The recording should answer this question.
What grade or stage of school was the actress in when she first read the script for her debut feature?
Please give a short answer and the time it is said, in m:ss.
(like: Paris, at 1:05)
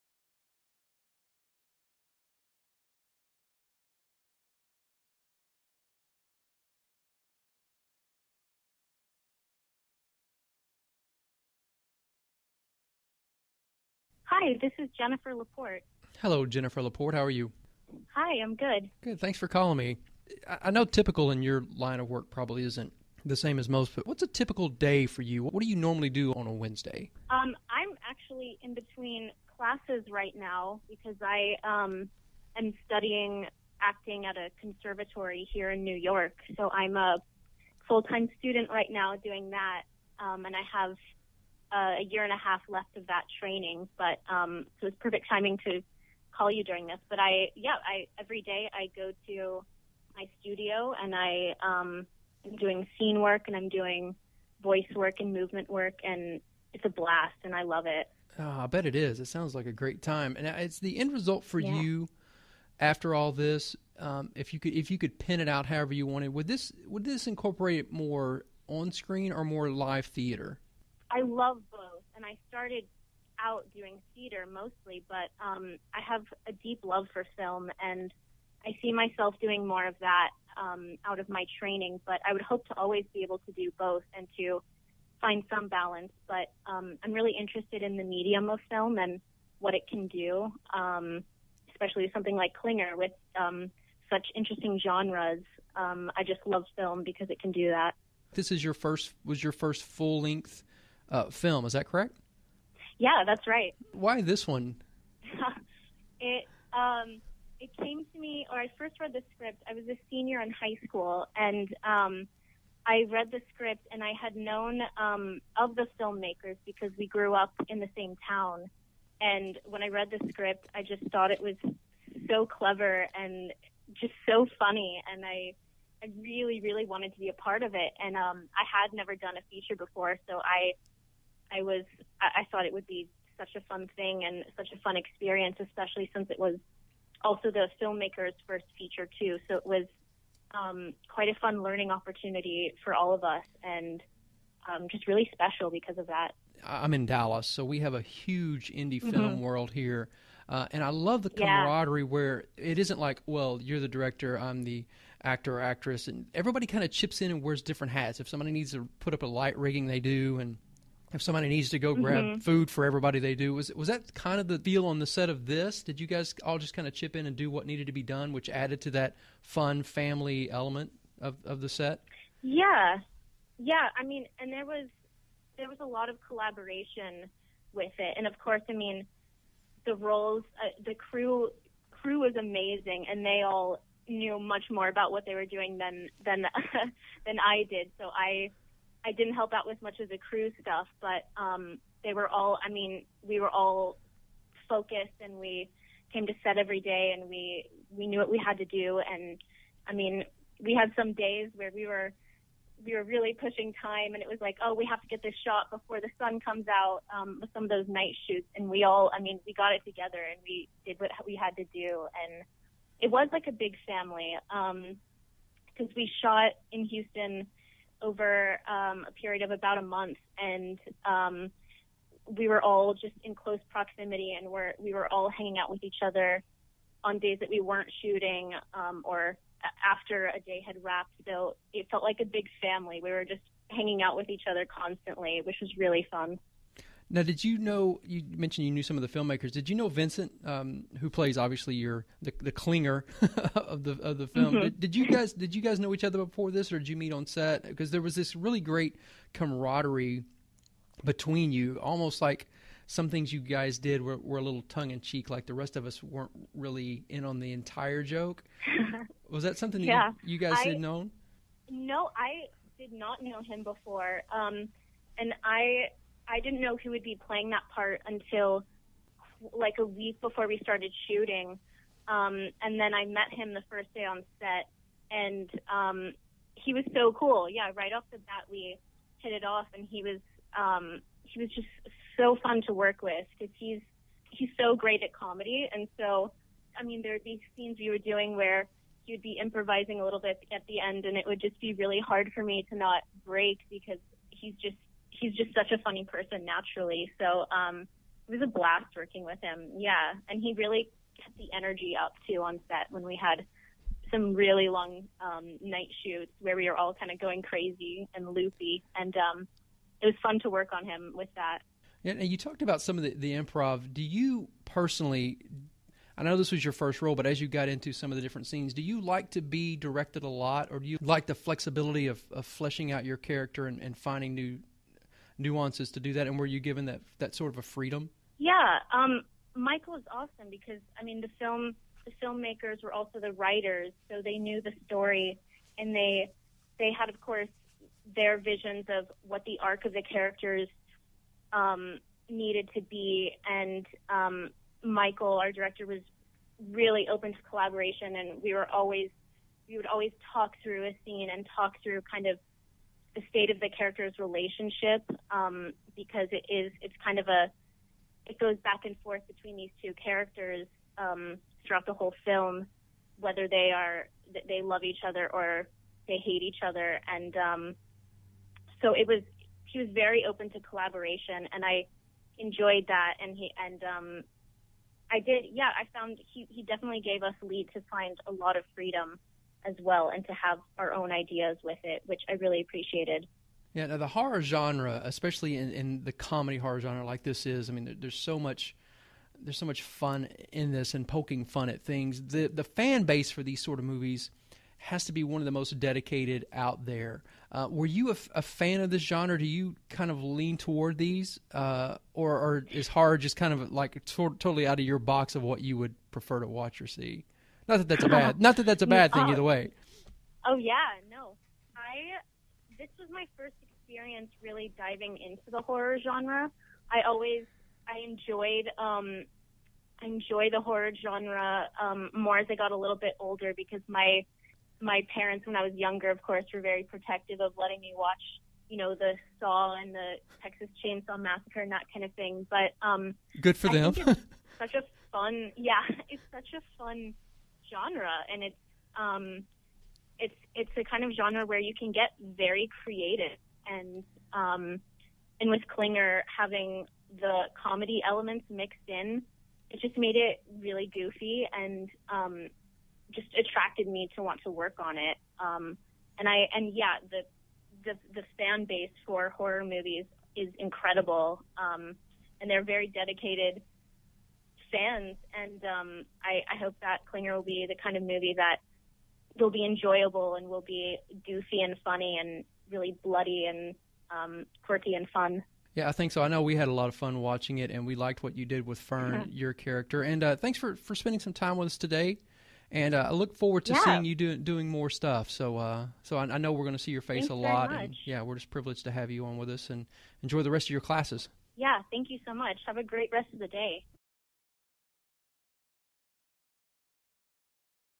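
senior in high school, at 1:50.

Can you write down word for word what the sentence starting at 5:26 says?
And were you given that that sort of a freedom?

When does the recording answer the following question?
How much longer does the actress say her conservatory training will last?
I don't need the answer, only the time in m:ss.
0:41.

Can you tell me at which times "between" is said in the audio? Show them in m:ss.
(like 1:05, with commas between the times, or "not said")
0:28, 4:11, 5:59.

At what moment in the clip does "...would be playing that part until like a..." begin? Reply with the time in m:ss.
4:26.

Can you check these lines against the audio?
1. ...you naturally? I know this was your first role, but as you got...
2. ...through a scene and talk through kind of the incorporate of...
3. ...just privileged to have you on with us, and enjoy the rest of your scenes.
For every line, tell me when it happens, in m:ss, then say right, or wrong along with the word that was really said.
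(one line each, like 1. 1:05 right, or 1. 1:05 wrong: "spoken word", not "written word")
1. 5:14 wrong: "personally", not "naturally"
2. 5:50 wrong: "state", not "incorporate"
3. 8:08 wrong: "classes", not "scenes".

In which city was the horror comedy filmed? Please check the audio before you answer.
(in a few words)
Houston.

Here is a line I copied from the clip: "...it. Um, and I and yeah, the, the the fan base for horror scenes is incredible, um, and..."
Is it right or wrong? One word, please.
wrong.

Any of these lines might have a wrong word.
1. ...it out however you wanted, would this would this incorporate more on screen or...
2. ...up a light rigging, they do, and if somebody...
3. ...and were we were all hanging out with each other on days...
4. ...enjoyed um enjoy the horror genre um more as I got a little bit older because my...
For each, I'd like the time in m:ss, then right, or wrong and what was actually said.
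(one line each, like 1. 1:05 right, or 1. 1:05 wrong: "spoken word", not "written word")
1. 1:05 right
2. 2:39 right
3. 3:44 right
4. 6:58 right.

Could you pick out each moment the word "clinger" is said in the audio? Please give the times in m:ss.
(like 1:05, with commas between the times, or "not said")
1:32, 4:02, 7:25, 7:47.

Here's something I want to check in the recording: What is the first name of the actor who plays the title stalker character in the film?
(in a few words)
Vincent.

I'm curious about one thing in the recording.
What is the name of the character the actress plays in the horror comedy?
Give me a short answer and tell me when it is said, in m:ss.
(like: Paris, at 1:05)
Fern, at 7:58.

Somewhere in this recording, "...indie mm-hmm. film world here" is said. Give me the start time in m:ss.
2:28.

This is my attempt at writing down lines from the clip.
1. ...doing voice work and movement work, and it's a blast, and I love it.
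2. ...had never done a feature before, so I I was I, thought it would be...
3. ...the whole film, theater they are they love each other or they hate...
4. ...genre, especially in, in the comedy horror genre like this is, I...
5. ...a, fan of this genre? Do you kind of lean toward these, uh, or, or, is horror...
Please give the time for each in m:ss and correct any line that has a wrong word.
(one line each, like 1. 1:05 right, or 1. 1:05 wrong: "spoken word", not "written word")
1. 0:53 right
2. 2:08 right
3. 6:01 wrong: "whether", not "theater"
4. 6:24 right
5. 6:38 right.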